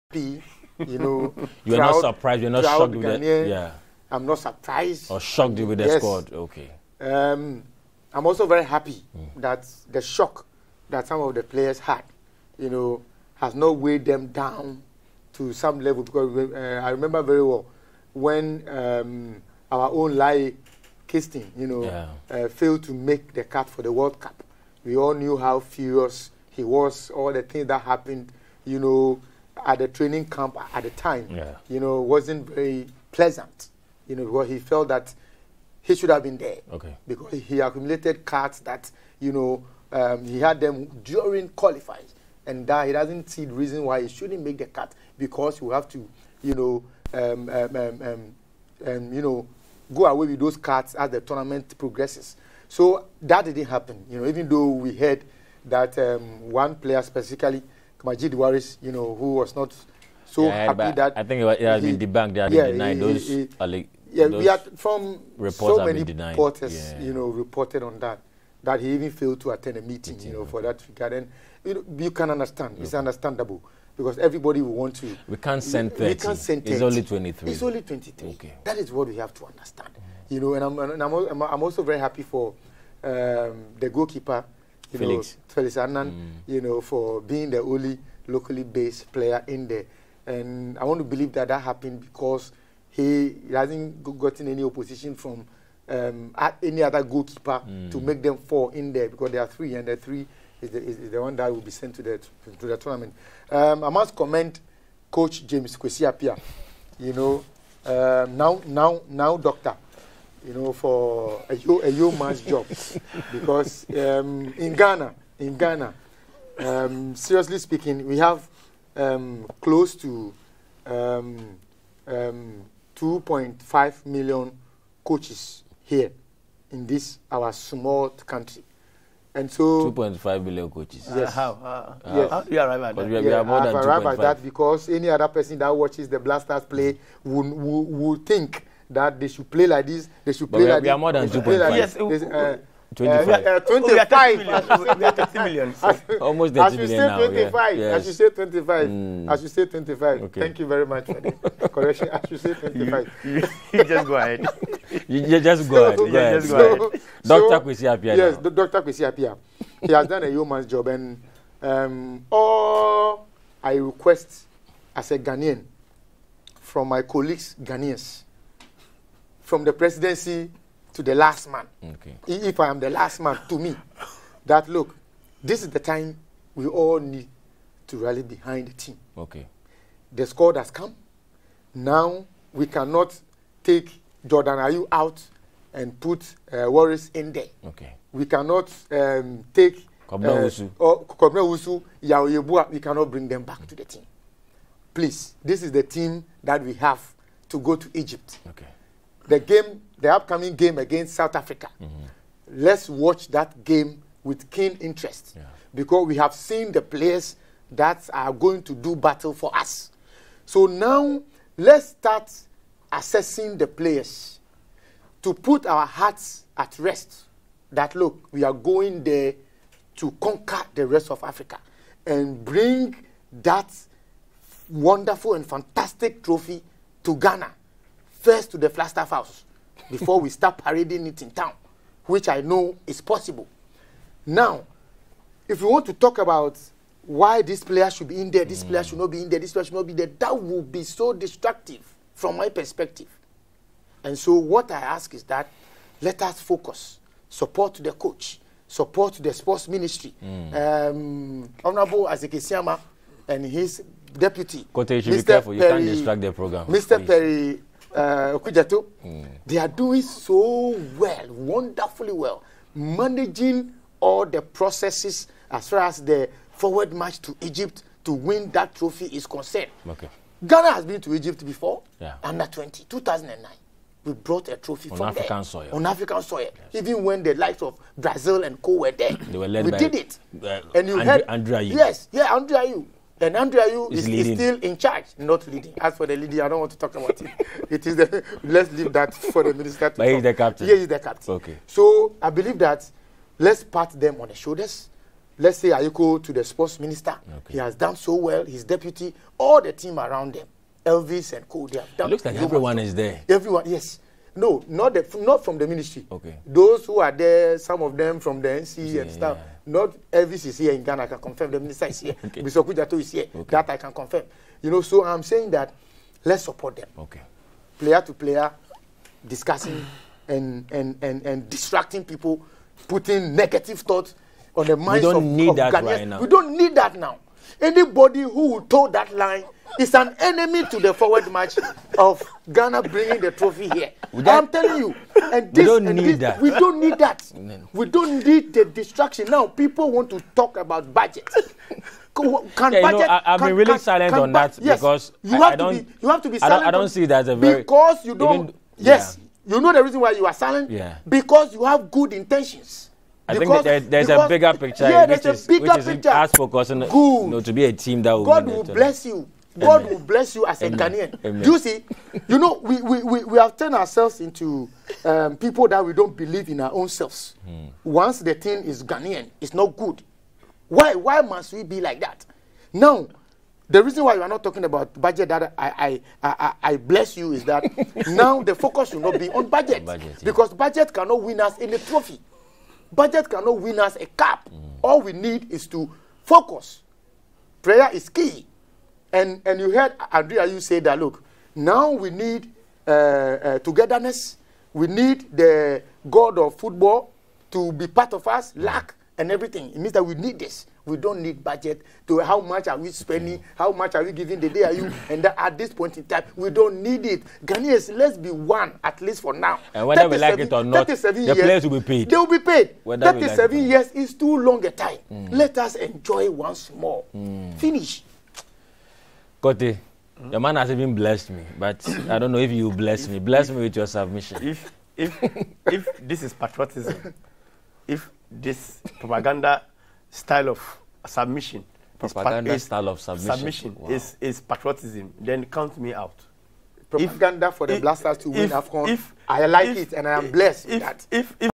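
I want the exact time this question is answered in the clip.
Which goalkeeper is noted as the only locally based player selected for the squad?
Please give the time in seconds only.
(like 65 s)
85 s.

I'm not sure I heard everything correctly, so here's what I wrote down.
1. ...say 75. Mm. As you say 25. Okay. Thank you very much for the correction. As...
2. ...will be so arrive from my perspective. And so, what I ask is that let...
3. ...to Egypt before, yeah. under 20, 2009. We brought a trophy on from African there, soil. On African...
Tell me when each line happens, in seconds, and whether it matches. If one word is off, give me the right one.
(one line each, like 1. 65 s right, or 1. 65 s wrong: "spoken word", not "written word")
1. 148 s wrong: "25", not "75"
2. 240 s wrong: "destructive", not "arrive"
3. 271 s right.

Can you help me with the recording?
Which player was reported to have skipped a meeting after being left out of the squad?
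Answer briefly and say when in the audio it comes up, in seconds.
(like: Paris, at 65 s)
Majid Waris, at 58 s.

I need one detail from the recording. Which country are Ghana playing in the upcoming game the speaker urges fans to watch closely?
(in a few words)
South Africa.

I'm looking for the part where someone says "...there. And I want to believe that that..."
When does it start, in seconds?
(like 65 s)
89 s.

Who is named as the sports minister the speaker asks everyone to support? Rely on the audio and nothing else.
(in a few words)
Isaac Asiamah.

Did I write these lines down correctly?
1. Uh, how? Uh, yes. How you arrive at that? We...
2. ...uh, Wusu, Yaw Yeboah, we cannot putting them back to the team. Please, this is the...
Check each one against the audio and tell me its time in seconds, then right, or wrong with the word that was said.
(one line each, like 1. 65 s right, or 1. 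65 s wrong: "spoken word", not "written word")
1. 131 s right
2. 190 s wrong: "bring", not "putting".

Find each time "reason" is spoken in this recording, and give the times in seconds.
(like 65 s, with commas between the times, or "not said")
43 s, 349 s, 373 s.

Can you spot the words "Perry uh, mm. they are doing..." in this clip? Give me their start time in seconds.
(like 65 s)
257 s.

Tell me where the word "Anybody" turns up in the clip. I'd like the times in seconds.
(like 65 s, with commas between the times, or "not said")
327 s.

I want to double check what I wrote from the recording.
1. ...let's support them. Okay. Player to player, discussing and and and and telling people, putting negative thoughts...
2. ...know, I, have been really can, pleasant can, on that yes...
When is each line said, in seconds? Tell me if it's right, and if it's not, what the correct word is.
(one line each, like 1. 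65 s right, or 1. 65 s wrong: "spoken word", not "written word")
1. 316 s wrong: "distracting", not "telling"
2. 342 s wrong: "silent", not "pleasant".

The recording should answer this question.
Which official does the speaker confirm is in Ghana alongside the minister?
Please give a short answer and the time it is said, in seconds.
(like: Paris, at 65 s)
Mr. Kujato, at 312 s.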